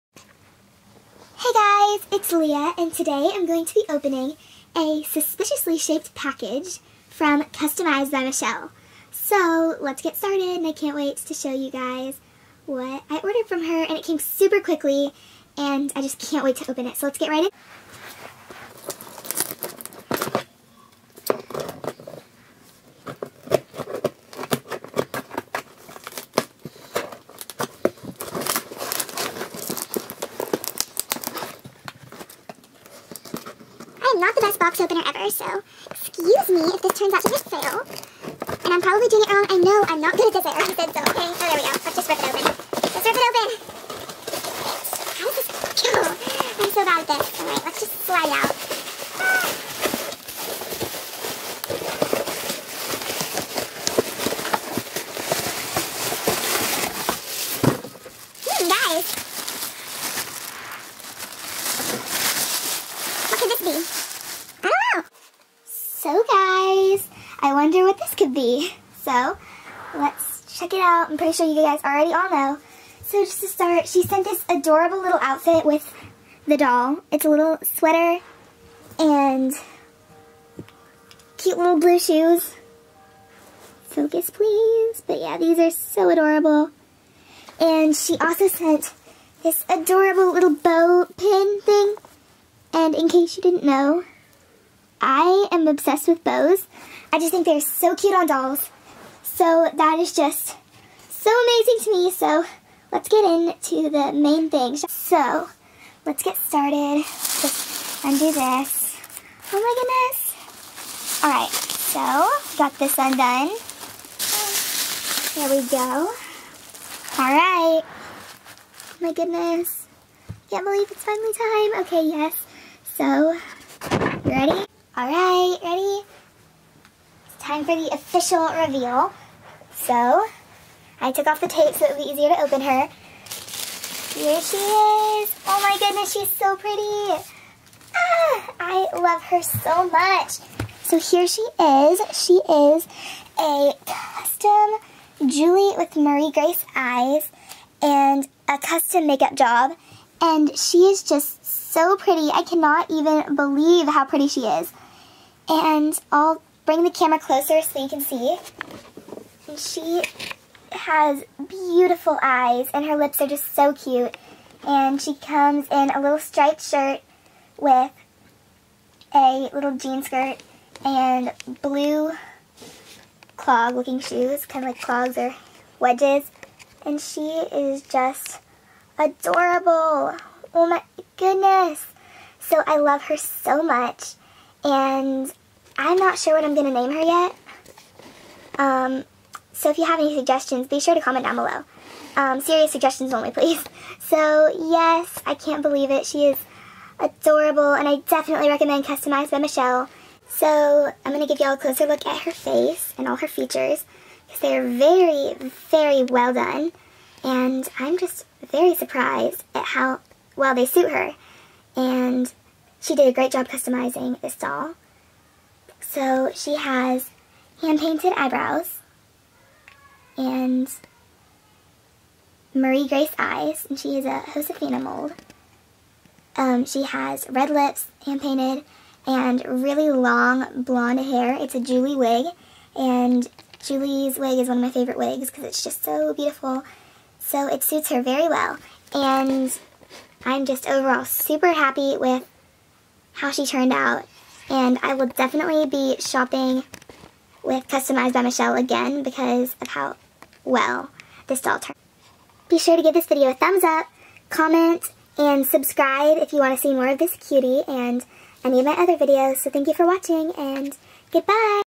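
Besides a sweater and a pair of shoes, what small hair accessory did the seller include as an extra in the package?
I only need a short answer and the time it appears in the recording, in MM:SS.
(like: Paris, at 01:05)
Bow pin, at 01:30.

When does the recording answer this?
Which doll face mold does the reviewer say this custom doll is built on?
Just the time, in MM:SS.
03:44.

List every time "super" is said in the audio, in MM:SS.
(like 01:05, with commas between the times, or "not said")
00:14, 04:01.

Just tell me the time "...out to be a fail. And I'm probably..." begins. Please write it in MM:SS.
00:37.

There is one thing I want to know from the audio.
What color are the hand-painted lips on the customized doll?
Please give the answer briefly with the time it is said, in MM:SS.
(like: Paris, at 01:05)
Red, at 03:47.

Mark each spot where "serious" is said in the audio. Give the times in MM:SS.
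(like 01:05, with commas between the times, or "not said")
03:12.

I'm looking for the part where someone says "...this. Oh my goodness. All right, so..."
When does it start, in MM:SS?
01:48.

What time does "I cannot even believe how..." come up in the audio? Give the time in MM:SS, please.
02:32.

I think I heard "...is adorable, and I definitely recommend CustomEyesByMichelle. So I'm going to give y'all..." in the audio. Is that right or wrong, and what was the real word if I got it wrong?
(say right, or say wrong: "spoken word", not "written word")
right.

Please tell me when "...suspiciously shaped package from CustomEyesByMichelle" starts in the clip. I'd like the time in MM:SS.
00:05.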